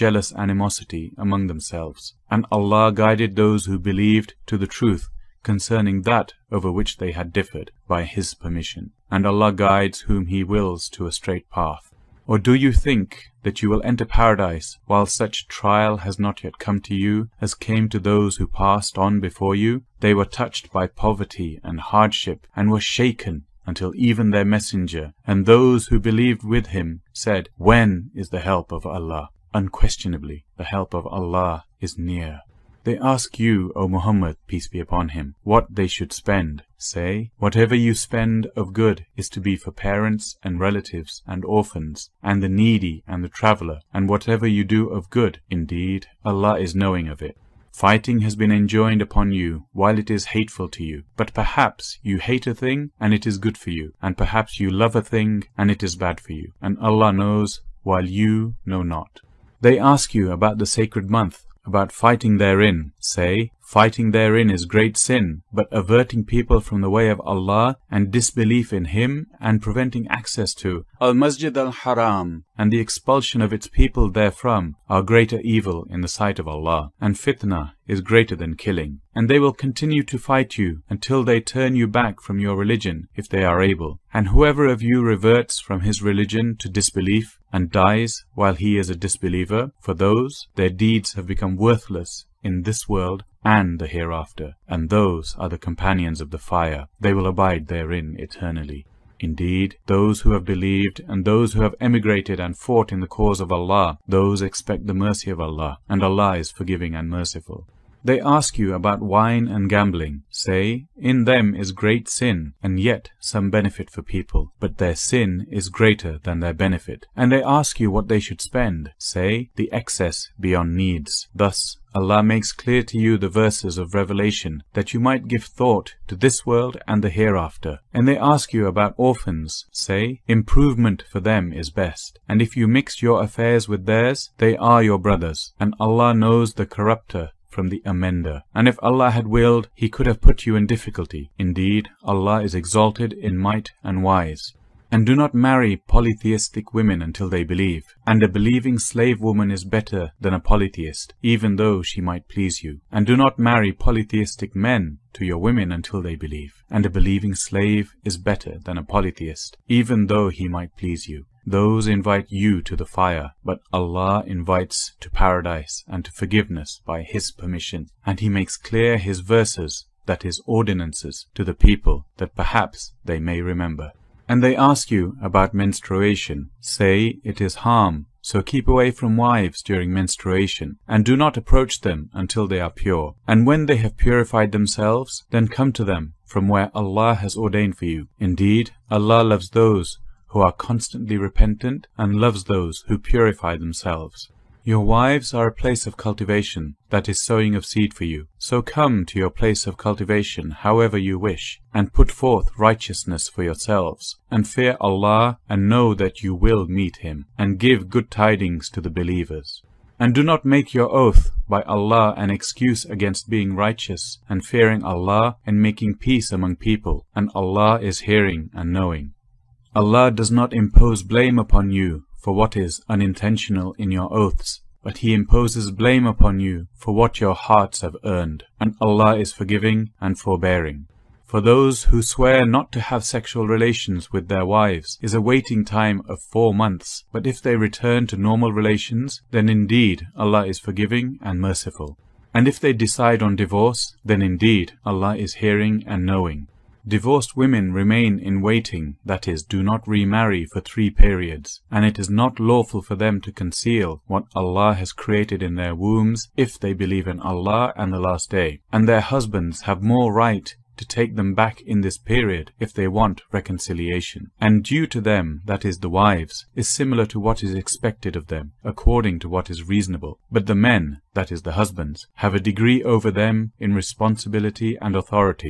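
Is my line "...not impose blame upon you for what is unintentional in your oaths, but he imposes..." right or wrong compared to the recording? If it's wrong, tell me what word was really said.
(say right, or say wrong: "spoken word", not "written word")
right.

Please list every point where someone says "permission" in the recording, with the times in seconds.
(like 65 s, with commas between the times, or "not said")
8 s, 167 s.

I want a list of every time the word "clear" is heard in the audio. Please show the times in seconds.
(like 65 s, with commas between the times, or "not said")
122 s, 168 s.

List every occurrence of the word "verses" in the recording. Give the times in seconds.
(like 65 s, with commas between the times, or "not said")
123 s, 169 s.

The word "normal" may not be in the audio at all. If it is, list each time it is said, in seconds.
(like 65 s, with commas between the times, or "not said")
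238 s.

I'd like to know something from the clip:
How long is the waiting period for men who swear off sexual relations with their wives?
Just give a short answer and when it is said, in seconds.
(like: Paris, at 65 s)
4 months, at 236 s.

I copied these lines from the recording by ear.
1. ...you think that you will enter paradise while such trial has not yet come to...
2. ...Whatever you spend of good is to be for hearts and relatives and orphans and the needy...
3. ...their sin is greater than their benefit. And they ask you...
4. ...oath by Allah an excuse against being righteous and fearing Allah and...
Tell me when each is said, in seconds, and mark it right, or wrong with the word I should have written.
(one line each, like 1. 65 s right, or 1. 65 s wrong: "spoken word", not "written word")
1. 12 s right
2. 37 s wrong: "parents", not "hearts"
3. 114 s right
4. 210 s right.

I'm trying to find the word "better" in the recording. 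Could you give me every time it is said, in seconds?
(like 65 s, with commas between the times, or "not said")
149 s, 158 s.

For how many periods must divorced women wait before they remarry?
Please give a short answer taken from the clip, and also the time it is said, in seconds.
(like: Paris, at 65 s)
3, at 250 s.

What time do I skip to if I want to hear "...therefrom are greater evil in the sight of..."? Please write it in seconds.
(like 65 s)
74 s.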